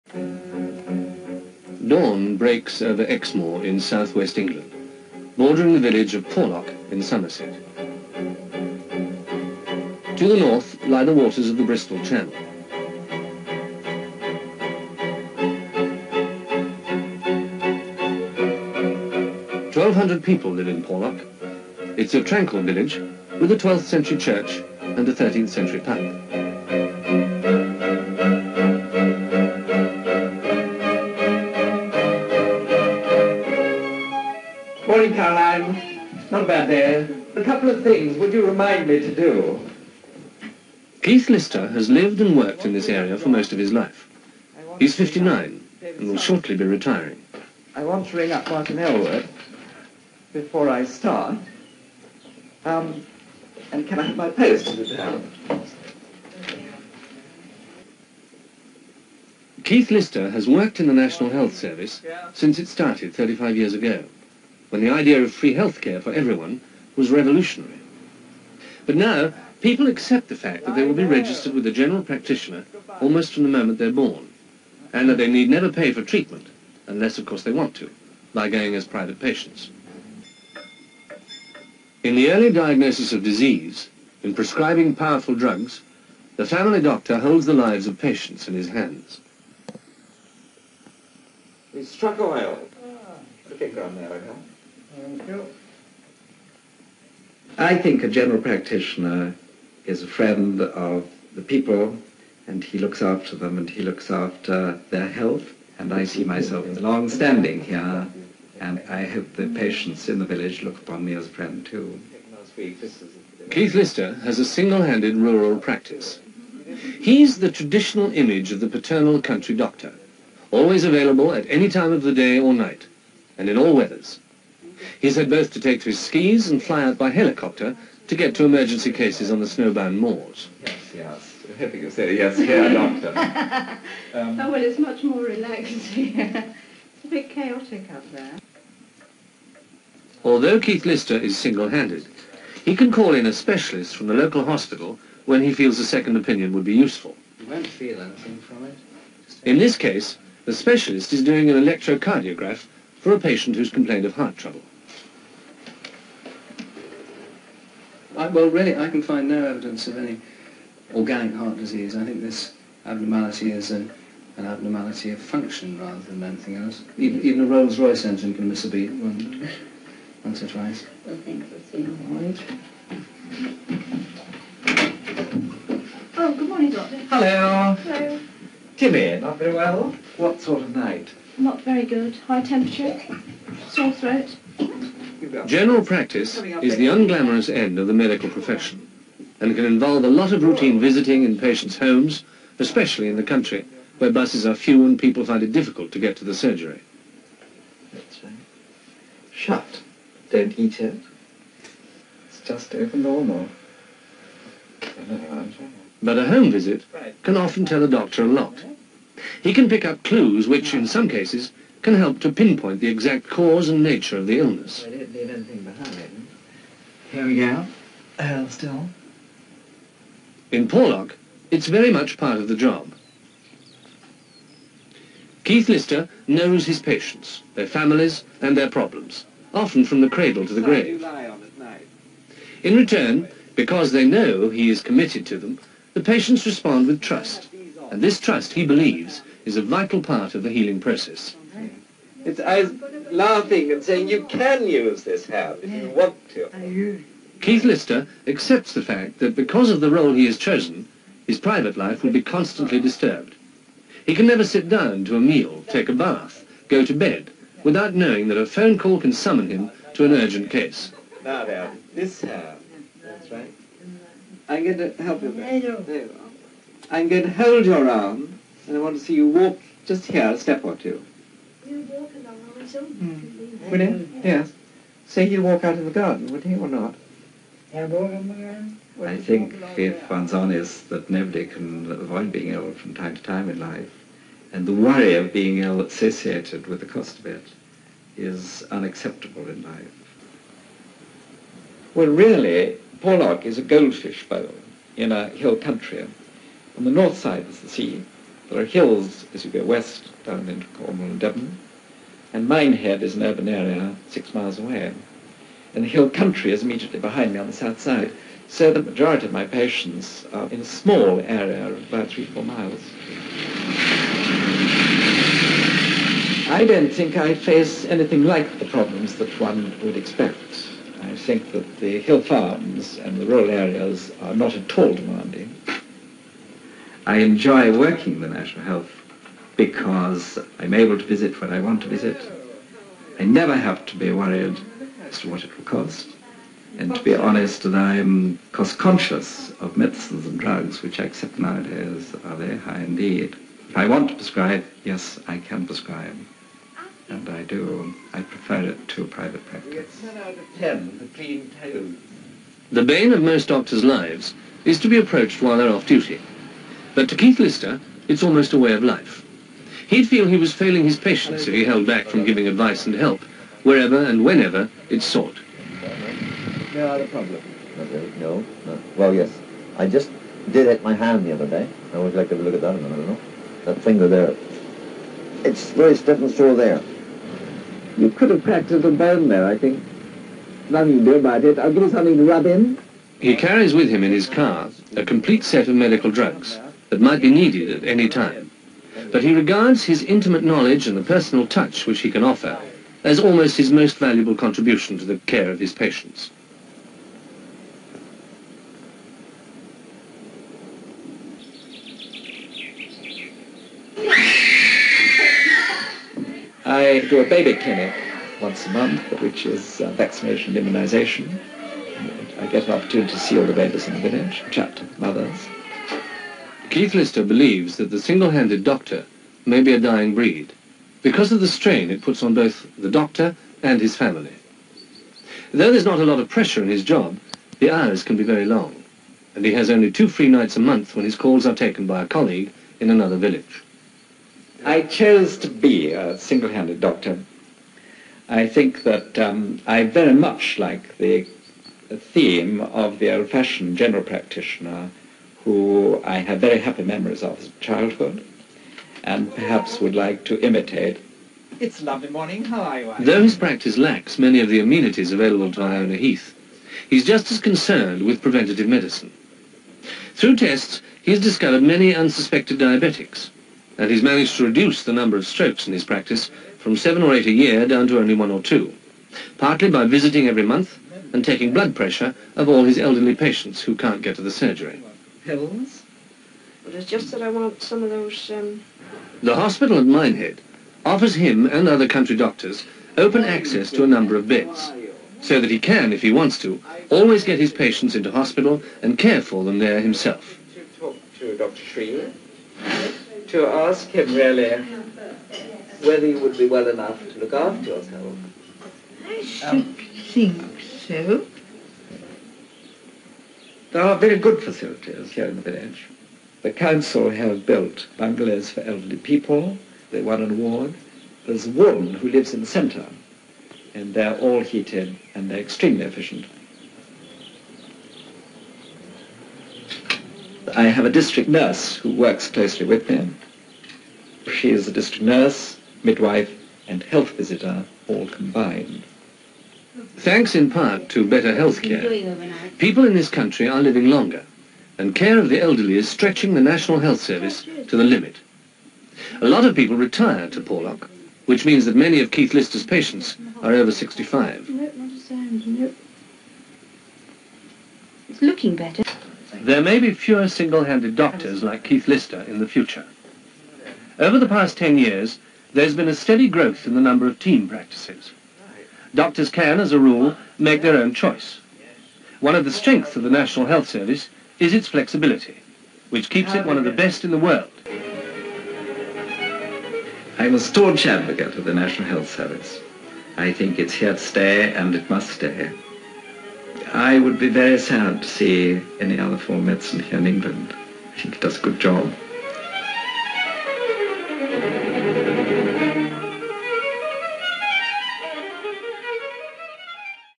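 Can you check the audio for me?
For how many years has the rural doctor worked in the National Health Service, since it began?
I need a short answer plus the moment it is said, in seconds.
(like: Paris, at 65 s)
35, at 63 s.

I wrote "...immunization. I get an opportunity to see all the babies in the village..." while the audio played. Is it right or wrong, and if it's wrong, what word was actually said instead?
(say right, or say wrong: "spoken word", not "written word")
right.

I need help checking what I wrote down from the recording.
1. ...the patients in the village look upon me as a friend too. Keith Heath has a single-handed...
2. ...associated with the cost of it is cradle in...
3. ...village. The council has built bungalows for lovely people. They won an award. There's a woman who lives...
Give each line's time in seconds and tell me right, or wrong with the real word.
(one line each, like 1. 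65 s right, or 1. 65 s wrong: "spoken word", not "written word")
1. 109 s wrong: "Lister", not "Heath"
2. 285 s wrong: "unacceptable", not "cradle"
3. 505 s wrong: "elderly", not "lovely".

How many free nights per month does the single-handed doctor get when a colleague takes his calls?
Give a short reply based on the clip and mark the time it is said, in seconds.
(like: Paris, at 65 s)
2, at 429 s.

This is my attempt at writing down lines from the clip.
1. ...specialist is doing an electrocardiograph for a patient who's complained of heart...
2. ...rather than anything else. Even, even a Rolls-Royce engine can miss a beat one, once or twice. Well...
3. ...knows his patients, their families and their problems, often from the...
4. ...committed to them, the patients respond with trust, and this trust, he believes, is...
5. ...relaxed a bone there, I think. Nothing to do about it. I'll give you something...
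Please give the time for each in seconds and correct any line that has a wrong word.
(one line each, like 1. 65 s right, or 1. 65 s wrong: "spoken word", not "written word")
1. 150 s right
2. 165 s right
3. 226 s right
4. 234 s right
5. 378 s wrong: "practiced", not "relaxed".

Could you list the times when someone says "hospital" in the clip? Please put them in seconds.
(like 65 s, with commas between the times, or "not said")
144 s, 479 s, 488 s.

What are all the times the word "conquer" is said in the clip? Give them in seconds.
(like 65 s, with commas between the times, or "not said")
not said.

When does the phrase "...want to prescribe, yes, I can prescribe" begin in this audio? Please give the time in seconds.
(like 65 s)
343 s.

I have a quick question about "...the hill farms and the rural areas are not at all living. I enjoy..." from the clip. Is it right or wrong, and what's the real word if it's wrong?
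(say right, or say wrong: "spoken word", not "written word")
wrong: "demanding", not "living".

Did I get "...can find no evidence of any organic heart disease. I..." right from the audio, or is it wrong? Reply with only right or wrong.
right.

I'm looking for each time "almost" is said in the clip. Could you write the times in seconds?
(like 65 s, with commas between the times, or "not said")
73 s, 358 s, 393 s.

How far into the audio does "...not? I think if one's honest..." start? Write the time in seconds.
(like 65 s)
276 s.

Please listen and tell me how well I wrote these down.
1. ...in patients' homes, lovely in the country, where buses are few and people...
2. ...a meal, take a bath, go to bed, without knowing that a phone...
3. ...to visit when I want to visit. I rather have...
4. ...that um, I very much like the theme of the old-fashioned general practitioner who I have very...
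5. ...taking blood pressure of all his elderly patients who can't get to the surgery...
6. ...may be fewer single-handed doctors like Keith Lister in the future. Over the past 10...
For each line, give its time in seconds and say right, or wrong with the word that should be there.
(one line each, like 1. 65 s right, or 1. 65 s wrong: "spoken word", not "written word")
1. 191 s wrong: "especially", not "lovely"
2. 255 s right
3. 330 s wrong: "never", not "rather"
4. 438 s right
5. 471 s right
6. 549 s right.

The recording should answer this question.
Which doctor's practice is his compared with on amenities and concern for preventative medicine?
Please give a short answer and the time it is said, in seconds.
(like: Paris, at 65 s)
Iona Heath, at 455 s.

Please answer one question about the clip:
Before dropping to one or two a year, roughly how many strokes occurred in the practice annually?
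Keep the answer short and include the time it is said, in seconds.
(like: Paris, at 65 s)
7 or 8, at 466 s.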